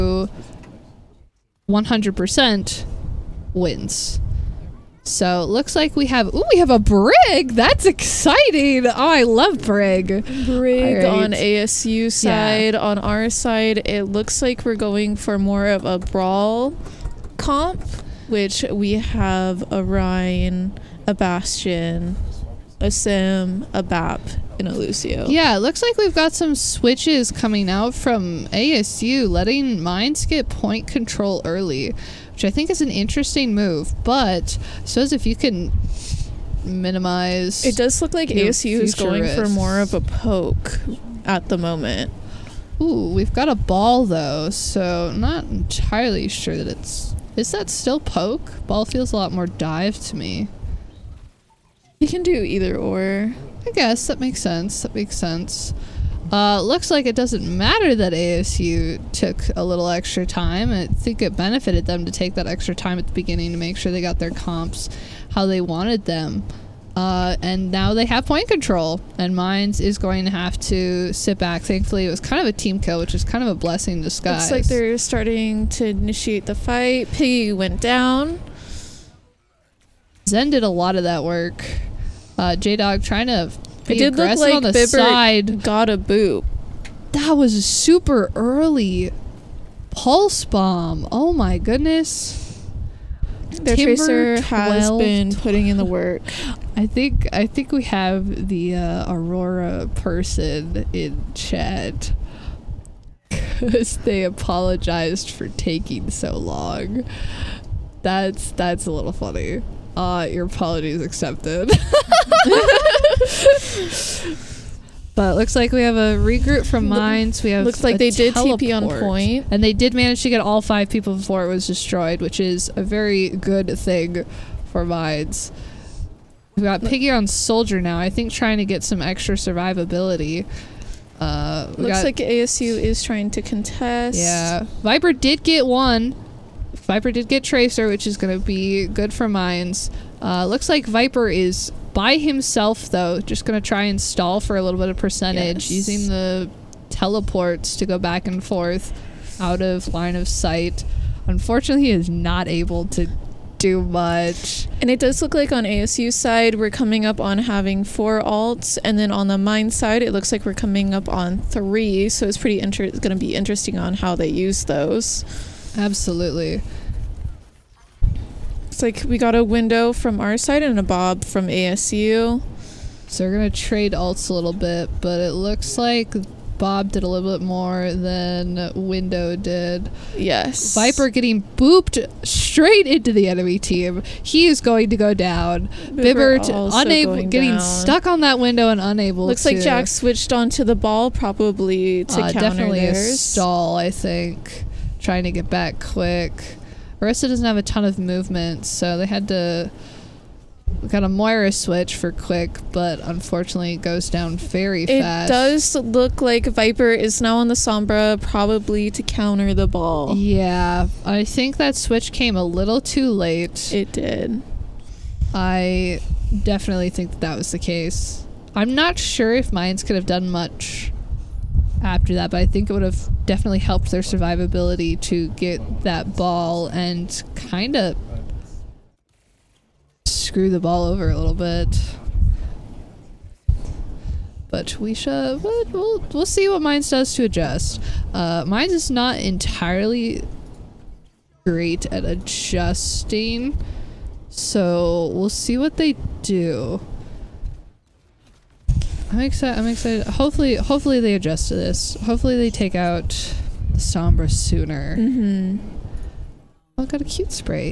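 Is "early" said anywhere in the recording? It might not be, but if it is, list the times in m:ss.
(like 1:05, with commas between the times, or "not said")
0:31, 1:28.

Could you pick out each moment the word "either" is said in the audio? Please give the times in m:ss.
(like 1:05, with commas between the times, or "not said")
0:52.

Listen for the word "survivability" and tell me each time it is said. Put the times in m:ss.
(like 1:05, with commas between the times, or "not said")
2:09, 3:44.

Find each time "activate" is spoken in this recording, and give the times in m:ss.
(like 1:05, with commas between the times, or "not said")
not said.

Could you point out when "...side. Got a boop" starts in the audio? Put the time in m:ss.
1:24.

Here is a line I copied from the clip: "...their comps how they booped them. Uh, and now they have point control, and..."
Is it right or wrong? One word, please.
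wrong.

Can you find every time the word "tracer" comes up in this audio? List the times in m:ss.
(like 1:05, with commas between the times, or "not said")
1:33, 2:17.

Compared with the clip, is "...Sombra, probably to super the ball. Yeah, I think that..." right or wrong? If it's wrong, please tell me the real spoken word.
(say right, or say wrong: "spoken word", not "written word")
wrong: "counter", not "super".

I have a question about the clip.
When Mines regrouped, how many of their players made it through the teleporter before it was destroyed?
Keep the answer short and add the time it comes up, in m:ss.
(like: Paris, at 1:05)
5, at 2:00.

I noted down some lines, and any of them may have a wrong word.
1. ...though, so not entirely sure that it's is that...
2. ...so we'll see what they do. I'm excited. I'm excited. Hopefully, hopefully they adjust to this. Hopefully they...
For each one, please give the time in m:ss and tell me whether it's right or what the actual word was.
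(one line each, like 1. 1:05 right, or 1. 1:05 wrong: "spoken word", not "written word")
1. 0:44 right
2. 4:04 right.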